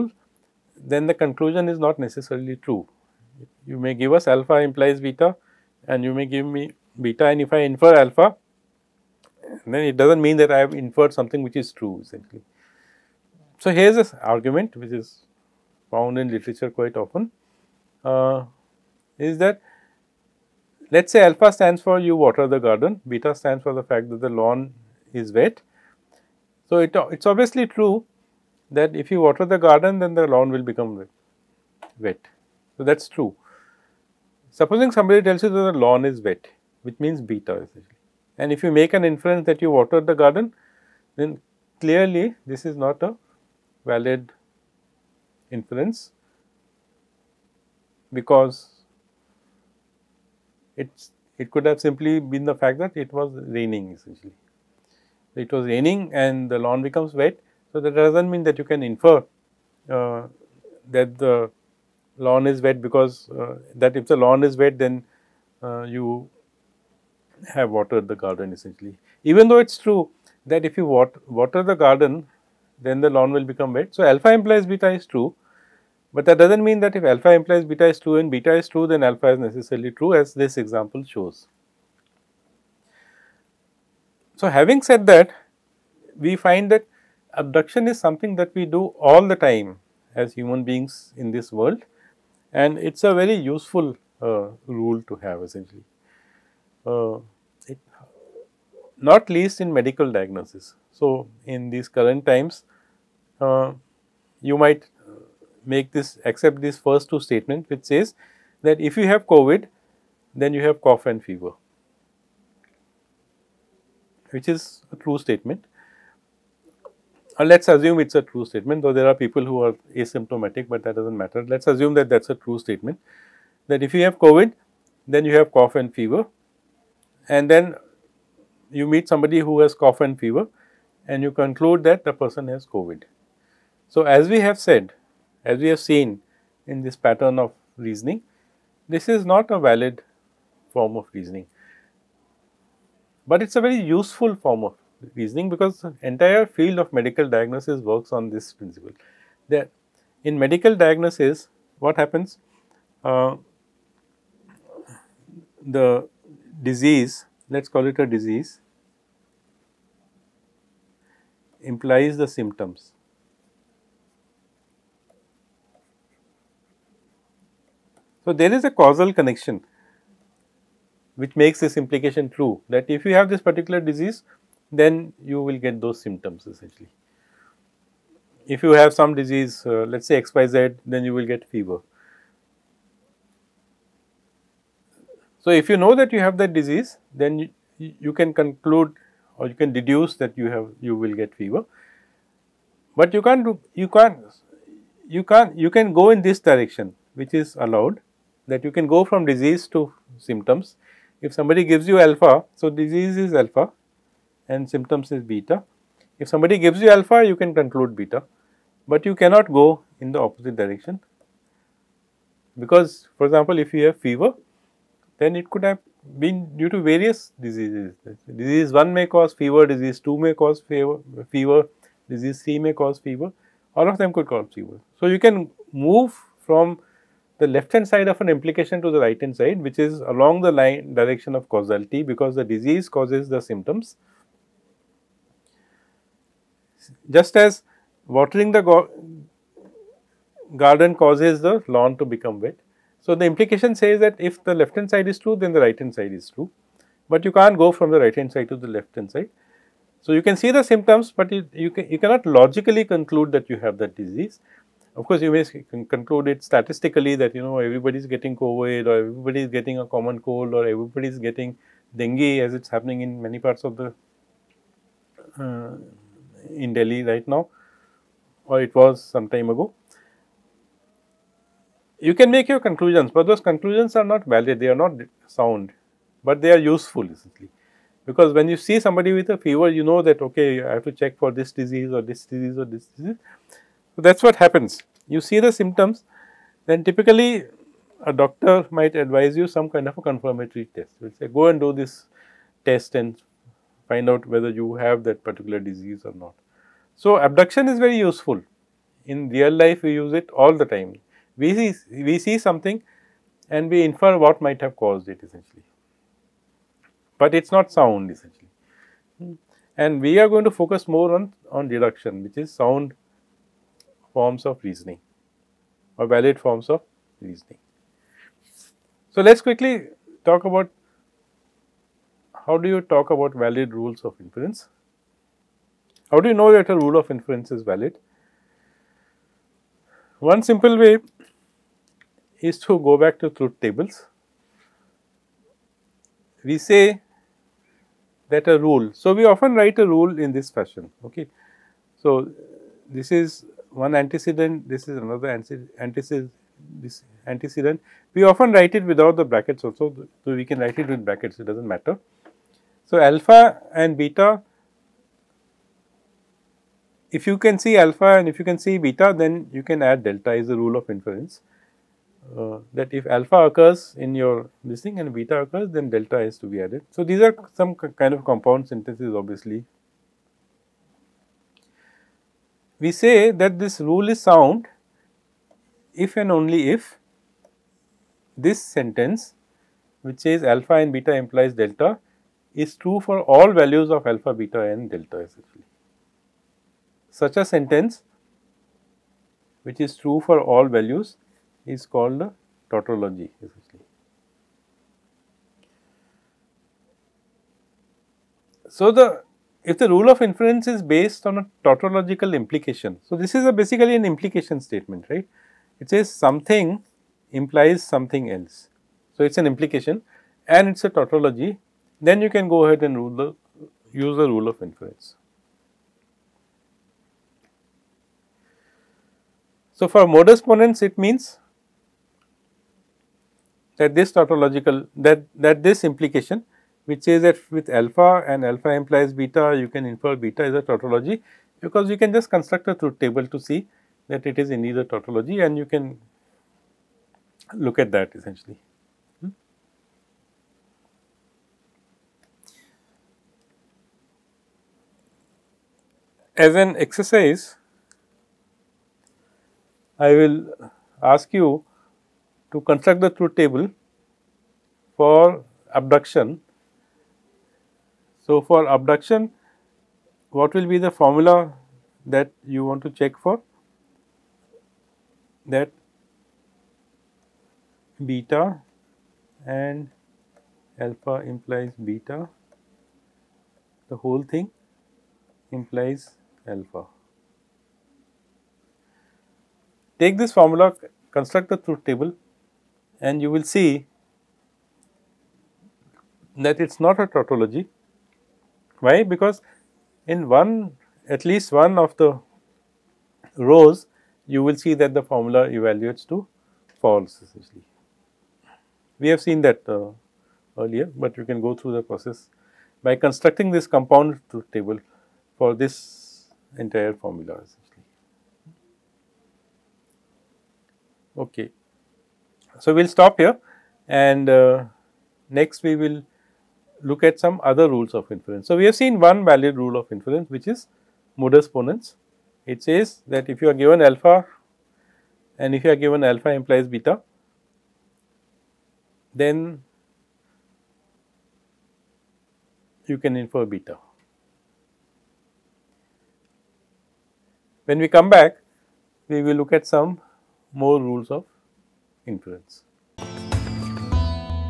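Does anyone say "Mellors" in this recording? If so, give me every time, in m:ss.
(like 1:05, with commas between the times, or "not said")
not said.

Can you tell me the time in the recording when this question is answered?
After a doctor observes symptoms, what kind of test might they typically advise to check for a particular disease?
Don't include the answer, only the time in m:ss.
4:50.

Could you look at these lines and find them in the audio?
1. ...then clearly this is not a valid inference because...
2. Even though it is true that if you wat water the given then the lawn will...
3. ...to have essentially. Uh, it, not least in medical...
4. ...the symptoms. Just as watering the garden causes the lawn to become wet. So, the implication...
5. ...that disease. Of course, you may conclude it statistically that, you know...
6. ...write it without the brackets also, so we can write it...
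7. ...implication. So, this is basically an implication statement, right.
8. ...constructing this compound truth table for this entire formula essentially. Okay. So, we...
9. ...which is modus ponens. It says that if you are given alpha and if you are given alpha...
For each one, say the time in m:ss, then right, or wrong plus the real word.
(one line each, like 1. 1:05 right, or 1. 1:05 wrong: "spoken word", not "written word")
1. 0:41 right
2. 1:09 wrong: "garden", not "given"
3. 1:35 right
4. 3:53 right
5. 4:13 right
6. 5:48 right
7. 6:42 right
8. 8:22 right
9. 8:40 right.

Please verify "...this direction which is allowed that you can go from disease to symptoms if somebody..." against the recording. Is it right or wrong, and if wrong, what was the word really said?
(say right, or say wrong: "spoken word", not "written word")
right.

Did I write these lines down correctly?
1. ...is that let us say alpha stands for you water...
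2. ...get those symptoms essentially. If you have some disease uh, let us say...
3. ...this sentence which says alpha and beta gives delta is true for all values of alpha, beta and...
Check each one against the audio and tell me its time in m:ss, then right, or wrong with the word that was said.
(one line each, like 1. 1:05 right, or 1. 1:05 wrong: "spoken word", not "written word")
1. 0:19 right
2. 2:55 right
3. 6:18 wrong: "implies", not "gives".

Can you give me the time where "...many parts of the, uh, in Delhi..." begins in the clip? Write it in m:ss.
4:23.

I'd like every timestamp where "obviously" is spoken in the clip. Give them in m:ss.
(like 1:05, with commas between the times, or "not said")
0:27, 6:09.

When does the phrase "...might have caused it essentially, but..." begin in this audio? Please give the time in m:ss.
5:04.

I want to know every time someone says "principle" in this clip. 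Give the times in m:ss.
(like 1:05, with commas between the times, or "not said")
2:28.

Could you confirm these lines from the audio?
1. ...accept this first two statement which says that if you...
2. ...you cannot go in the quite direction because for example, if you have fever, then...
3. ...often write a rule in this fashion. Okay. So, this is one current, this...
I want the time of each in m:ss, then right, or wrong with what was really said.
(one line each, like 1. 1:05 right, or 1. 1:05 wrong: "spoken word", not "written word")
1. 1:46 right
2. 3:29 wrong: "opposite", not "quite"
3. 5:39 wrong: "antecedent", not "current".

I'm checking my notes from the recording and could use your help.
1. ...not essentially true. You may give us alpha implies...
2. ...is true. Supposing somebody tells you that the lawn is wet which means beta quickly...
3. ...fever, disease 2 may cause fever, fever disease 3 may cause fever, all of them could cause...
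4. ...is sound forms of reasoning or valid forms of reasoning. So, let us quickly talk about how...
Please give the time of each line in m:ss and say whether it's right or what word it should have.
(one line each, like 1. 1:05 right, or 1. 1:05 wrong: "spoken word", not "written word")
1. 0:01 wrong: "necessarily", not "essentially"
2. 0:32 wrong: "essentially", not "quickly"
3. 3:39 right
4. 5:12 right.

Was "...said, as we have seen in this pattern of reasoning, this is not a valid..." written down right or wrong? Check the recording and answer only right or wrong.
right.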